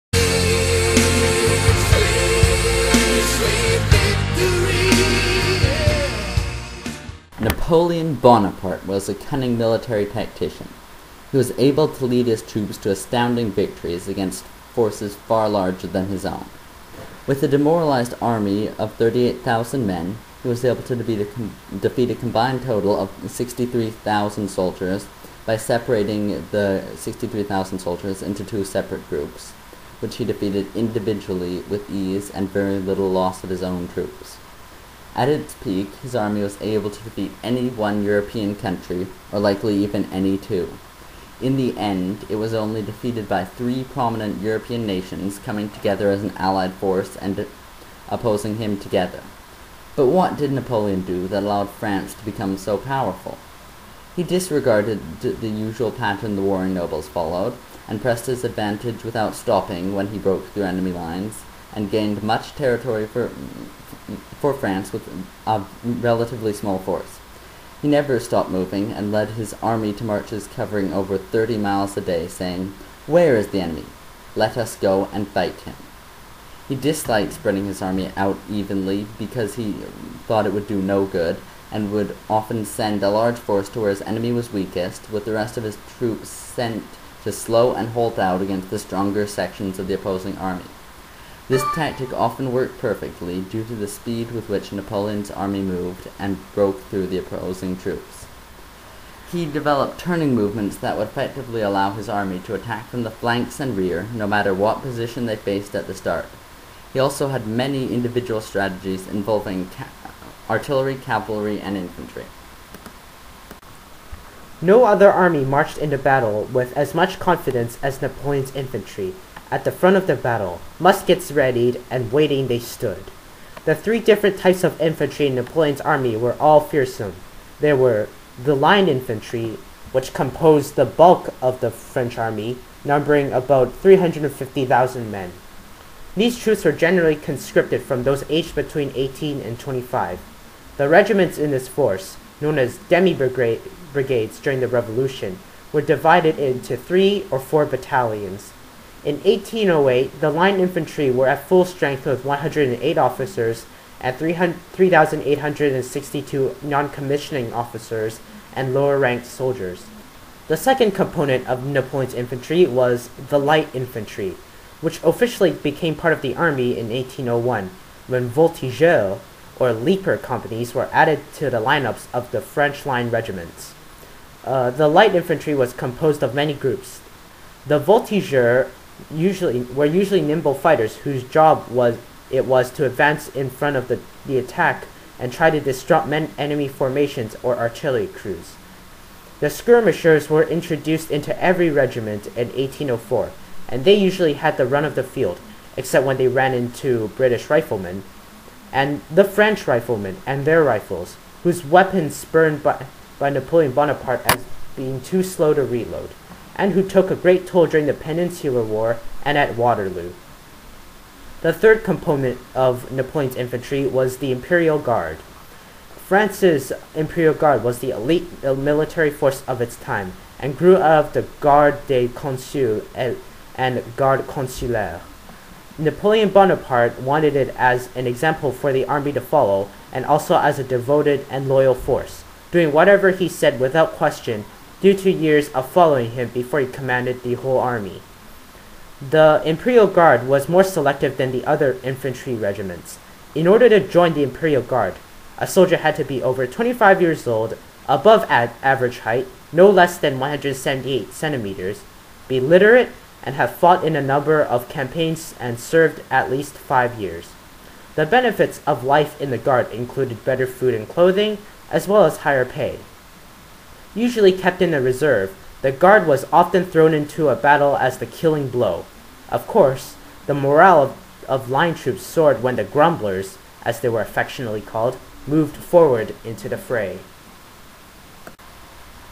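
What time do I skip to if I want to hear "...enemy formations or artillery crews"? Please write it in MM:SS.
03:06.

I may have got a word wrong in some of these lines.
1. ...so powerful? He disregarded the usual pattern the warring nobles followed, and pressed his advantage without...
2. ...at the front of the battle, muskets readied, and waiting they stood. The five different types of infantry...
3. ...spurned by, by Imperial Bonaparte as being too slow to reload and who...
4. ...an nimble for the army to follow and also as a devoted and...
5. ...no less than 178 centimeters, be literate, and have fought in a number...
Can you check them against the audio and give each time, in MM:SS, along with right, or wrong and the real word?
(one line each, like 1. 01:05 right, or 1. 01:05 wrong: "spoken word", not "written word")
1. 00:52 right
2. 01:59 wrong: "three", not "five"
3. 03:22 wrong: "Napoleon", not "Imperial"
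4. 03:47 wrong: "example", not "nimble"
5. 04:09 right.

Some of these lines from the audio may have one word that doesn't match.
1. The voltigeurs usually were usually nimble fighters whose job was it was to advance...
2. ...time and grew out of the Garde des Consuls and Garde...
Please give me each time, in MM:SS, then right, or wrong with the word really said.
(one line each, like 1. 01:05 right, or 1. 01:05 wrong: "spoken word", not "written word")
1. 02:57 right
2. 03:39 right.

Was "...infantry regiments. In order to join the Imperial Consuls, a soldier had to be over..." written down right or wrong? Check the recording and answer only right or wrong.
wrong.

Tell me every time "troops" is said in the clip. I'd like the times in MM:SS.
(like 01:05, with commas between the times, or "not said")
00:12, 00:33, 01:25, 01:37, 02:16, 04:31.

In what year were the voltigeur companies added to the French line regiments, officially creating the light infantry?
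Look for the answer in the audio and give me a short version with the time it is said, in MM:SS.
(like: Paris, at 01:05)
1801, at 02:46.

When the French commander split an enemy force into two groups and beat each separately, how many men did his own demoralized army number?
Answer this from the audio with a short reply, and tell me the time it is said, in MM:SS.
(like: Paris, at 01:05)
38,000, at 00:18.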